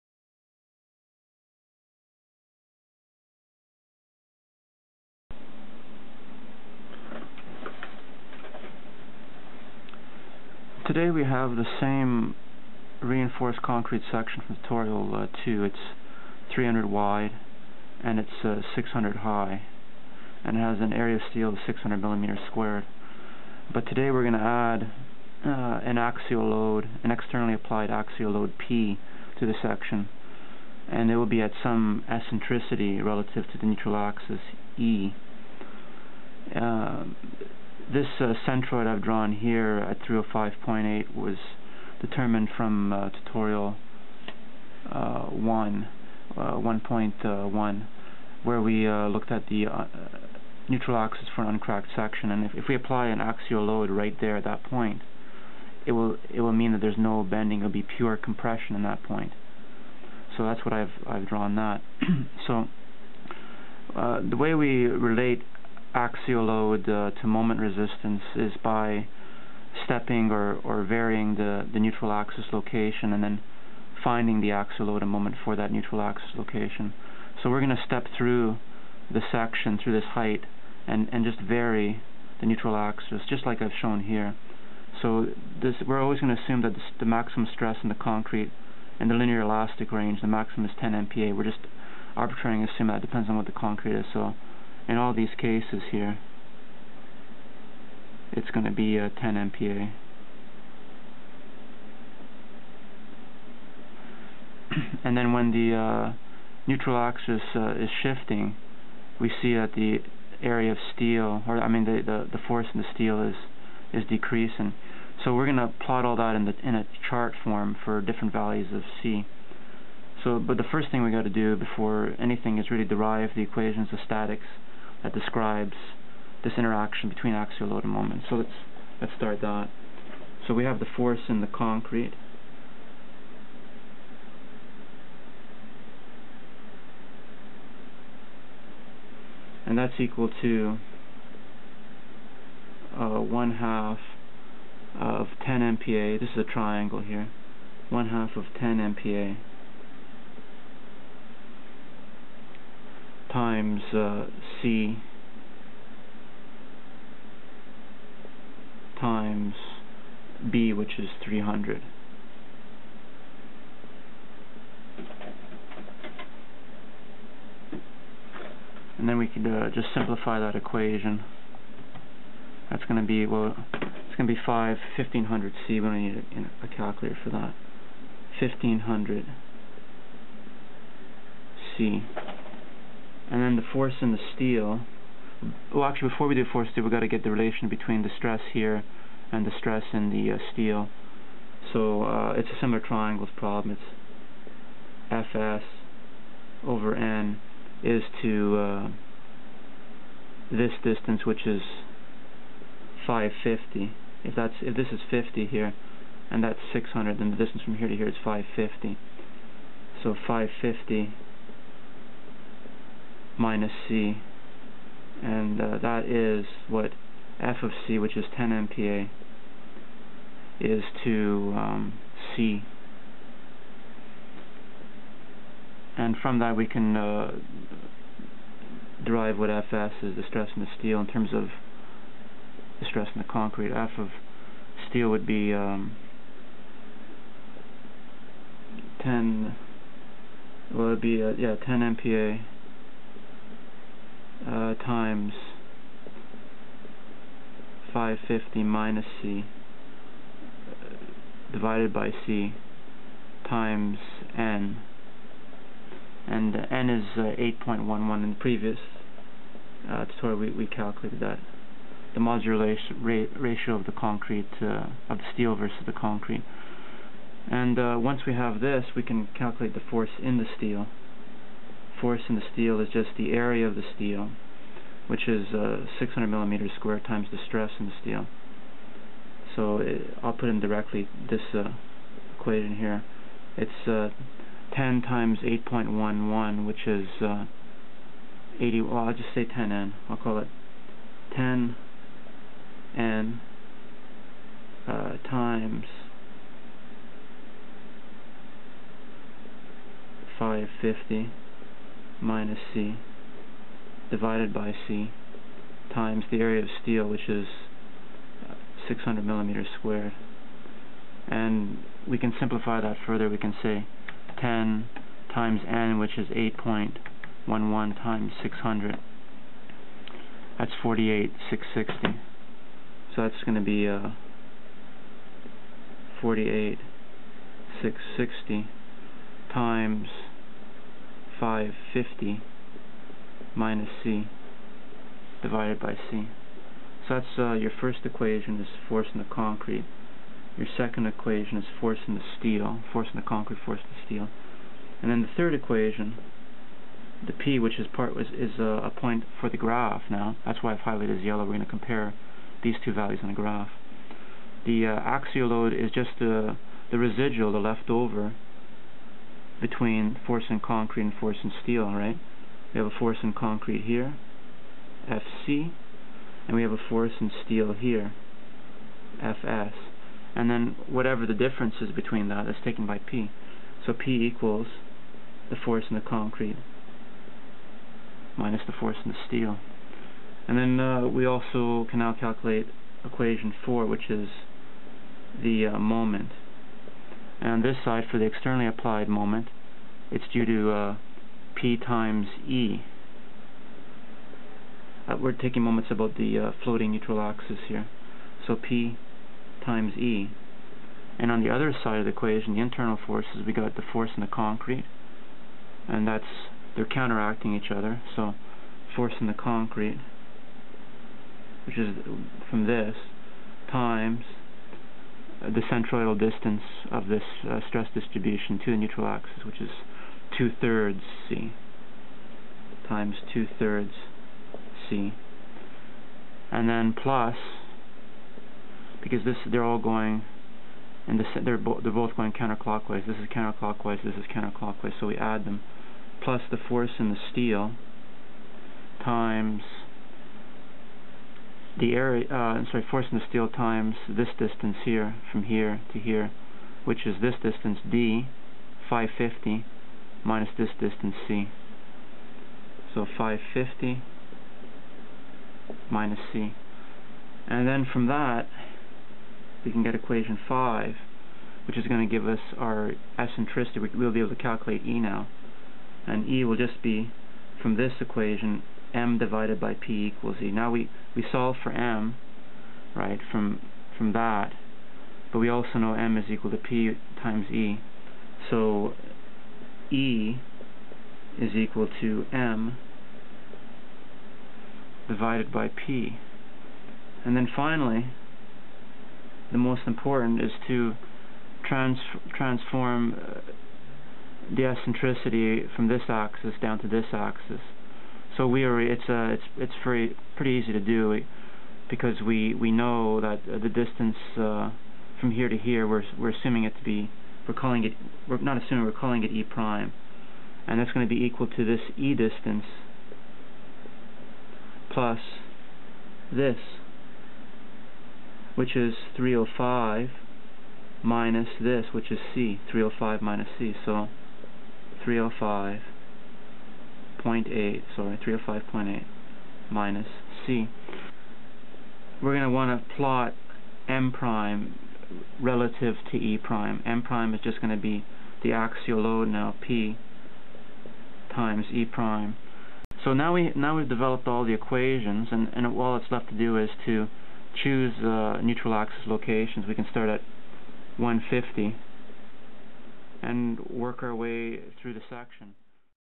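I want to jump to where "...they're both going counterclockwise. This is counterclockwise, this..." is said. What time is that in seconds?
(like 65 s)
431 s.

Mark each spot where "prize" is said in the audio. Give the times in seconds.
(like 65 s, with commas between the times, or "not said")
not said.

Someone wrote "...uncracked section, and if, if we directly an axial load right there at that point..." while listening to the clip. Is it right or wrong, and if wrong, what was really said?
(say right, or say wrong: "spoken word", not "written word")
wrong: "apply", not "directly".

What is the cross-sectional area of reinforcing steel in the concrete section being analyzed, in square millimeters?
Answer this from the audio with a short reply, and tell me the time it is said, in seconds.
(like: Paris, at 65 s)
600, at 20 s.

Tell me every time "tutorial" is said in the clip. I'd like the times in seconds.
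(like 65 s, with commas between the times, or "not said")
14 s, 43 s, 260 s.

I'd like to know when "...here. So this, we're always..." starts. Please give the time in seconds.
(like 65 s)
84 s.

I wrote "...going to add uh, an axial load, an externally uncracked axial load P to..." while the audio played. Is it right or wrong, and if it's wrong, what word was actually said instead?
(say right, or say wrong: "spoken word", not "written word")
wrong: "applied", not "uncracked".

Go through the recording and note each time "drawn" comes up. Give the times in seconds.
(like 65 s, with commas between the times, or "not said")
39 s, 61 s.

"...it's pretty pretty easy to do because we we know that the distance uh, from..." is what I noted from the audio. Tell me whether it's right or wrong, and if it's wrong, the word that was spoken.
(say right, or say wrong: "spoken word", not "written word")
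right.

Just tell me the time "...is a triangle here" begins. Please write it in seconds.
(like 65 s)
146 s.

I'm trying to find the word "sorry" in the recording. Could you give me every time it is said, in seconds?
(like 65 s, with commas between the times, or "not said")
442 s, 527 s.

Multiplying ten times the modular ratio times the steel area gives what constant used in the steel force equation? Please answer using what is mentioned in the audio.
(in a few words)
48,660.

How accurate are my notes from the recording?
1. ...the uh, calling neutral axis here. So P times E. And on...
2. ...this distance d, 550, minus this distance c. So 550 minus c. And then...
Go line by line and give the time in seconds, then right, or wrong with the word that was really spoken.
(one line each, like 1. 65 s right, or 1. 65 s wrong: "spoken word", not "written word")
1. 396 s wrong: "floating", not "calling"
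2. 447 s right.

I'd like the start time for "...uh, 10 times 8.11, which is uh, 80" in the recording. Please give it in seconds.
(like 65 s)
283 s.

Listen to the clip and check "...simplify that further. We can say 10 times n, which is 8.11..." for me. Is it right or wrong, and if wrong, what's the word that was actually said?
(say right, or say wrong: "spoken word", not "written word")
right.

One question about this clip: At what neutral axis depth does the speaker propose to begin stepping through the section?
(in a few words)
150.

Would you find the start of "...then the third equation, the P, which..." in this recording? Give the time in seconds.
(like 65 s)
345 s.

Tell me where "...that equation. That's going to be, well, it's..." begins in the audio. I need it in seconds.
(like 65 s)
170 s.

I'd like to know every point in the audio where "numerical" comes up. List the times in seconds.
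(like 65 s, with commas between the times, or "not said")
not said.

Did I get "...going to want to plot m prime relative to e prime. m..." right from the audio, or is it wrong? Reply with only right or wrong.
right.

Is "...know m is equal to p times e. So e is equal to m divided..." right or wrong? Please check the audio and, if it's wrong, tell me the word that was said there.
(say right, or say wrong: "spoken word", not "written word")
right.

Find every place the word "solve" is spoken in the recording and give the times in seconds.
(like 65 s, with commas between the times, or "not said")
471 s.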